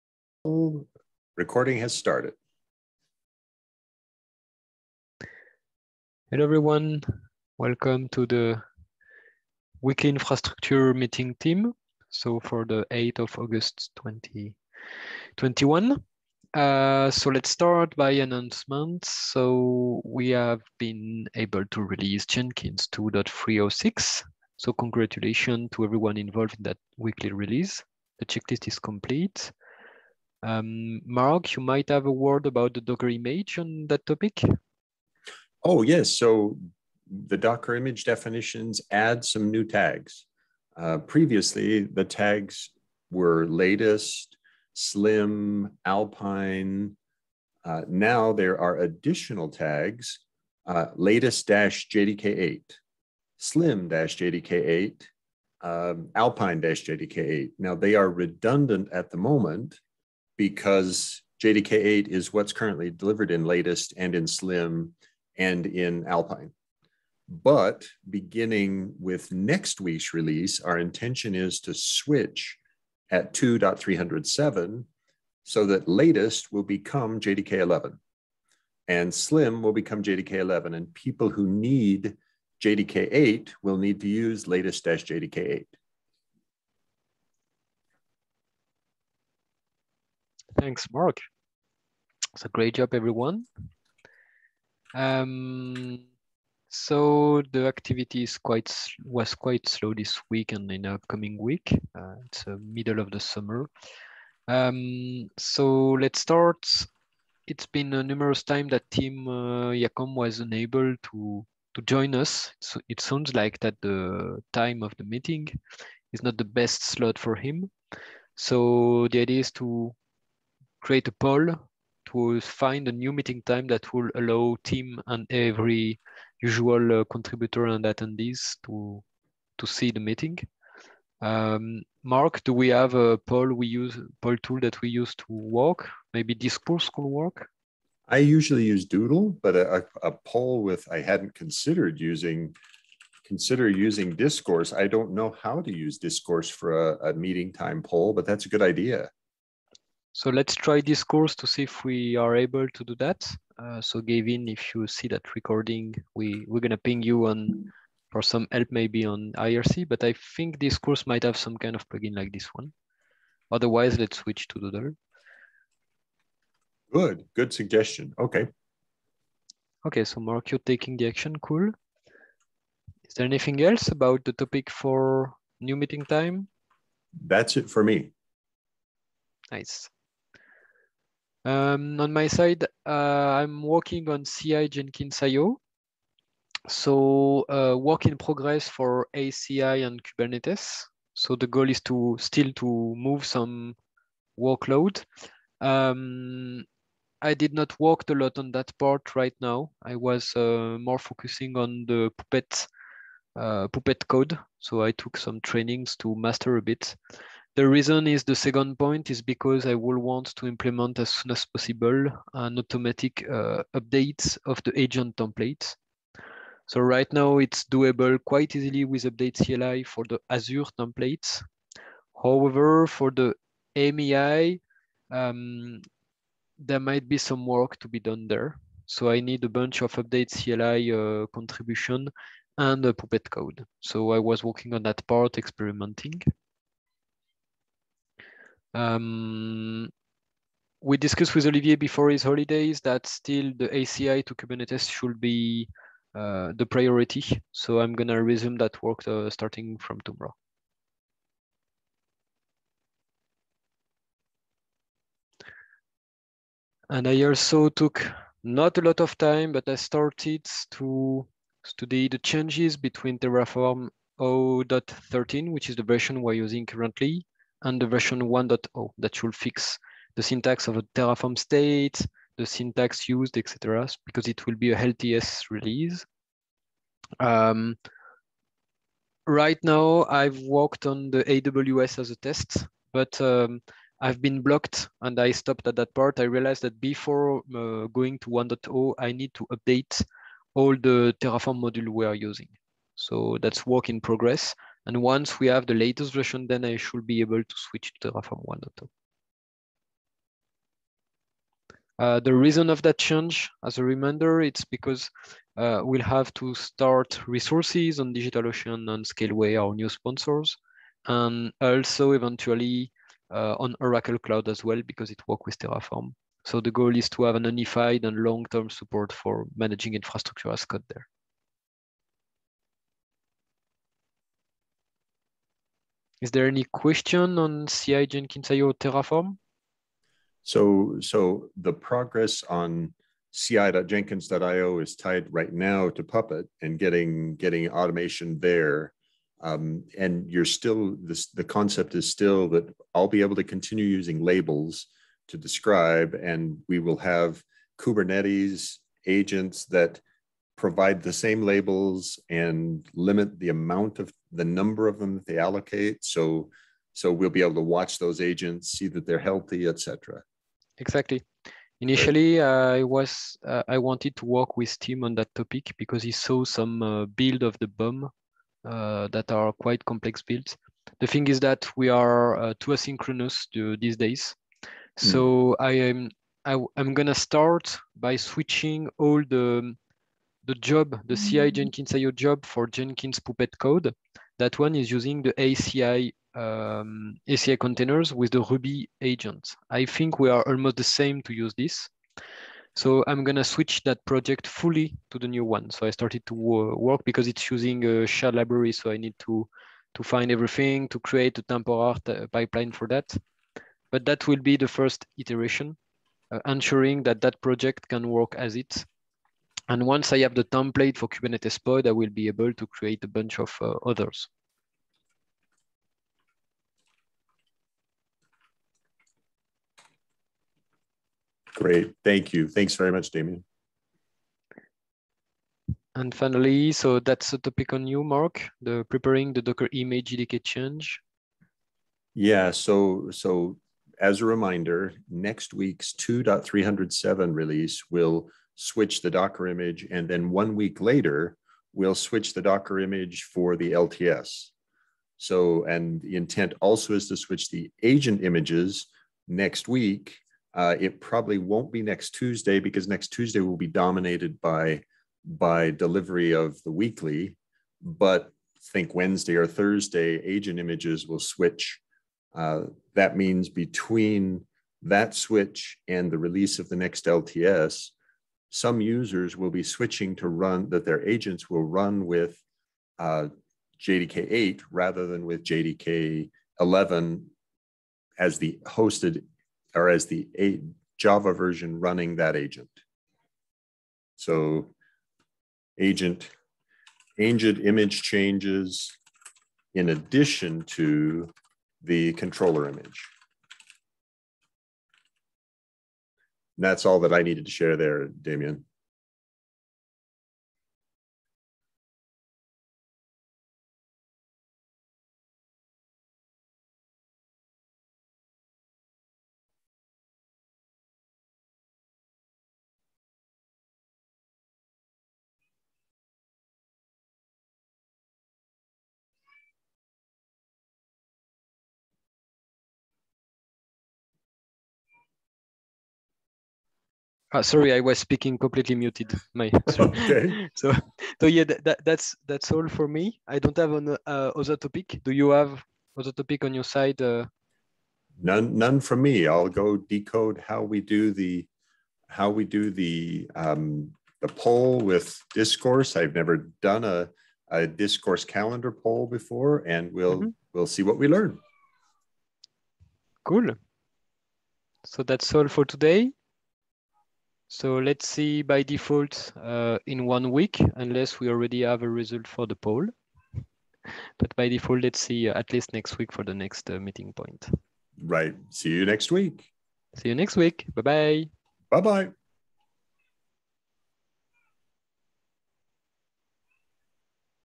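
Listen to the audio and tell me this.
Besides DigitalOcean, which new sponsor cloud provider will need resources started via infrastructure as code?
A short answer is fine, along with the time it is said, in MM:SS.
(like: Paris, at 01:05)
Scaleway, at 05:09.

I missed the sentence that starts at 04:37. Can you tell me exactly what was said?
Um, right now, I've worked on the AWS as a test, but um, I've been blocked and I stopped at that part.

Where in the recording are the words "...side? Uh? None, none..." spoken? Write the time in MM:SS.
08:56.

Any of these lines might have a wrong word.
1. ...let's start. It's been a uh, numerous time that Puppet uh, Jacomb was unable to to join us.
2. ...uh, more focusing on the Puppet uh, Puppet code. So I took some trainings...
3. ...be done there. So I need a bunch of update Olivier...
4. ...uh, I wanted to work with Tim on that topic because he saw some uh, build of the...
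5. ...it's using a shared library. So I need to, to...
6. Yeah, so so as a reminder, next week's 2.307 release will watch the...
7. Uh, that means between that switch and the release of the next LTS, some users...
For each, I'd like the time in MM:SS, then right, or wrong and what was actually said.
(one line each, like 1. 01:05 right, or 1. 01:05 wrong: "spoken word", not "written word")
1. 01:45 wrong: "Tim", not "Puppet"
2. 03:20 right
3. 03:47 wrong: "CLI", not "Olivier"
4. 06:03 right
5. 06:37 right
6. 07:12 wrong: "switch", not "watch"
7. 07:42 right.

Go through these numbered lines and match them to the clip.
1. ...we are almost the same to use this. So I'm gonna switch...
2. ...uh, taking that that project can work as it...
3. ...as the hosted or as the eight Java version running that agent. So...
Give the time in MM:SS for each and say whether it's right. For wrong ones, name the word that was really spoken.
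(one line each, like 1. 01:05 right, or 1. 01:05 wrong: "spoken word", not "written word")
1. 06:30 right
2. 06:46 wrong: "ensuring", not "taking"
3. 07:58 right.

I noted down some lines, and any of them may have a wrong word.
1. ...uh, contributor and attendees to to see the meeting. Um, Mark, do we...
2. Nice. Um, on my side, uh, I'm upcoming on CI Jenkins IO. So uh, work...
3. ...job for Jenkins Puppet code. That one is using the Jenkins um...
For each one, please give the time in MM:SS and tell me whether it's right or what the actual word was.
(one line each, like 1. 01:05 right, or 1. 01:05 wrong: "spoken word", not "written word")
1. 02:07 right
2. 02:59 wrong: "working", not "upcoming"
3. 06:22 wrong: "ACI", not "Jenkins".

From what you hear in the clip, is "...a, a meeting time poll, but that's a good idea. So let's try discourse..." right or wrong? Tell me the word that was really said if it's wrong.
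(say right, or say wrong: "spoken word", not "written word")
right.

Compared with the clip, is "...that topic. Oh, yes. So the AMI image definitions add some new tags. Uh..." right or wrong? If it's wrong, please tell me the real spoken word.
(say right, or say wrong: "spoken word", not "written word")
wrong: "Docker", not "AMI".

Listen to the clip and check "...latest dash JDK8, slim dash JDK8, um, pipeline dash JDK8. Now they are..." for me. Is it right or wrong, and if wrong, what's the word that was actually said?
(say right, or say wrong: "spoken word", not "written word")
wrong: "alpine", not "pipeline".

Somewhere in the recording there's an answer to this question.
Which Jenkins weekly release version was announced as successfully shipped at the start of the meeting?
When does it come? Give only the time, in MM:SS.
00:22.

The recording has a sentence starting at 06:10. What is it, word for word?
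The thing is that we are uh, too asynchronous to, these days, hmm.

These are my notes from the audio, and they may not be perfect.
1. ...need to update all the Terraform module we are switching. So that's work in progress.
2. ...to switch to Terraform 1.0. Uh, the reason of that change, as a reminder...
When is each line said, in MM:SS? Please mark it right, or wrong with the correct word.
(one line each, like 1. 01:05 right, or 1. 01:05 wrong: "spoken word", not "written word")
1. 04:49 wrong: "using", not "switching"
2. 04:57 right.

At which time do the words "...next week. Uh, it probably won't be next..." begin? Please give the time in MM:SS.
07:29.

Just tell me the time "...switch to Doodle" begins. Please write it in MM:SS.
02:44.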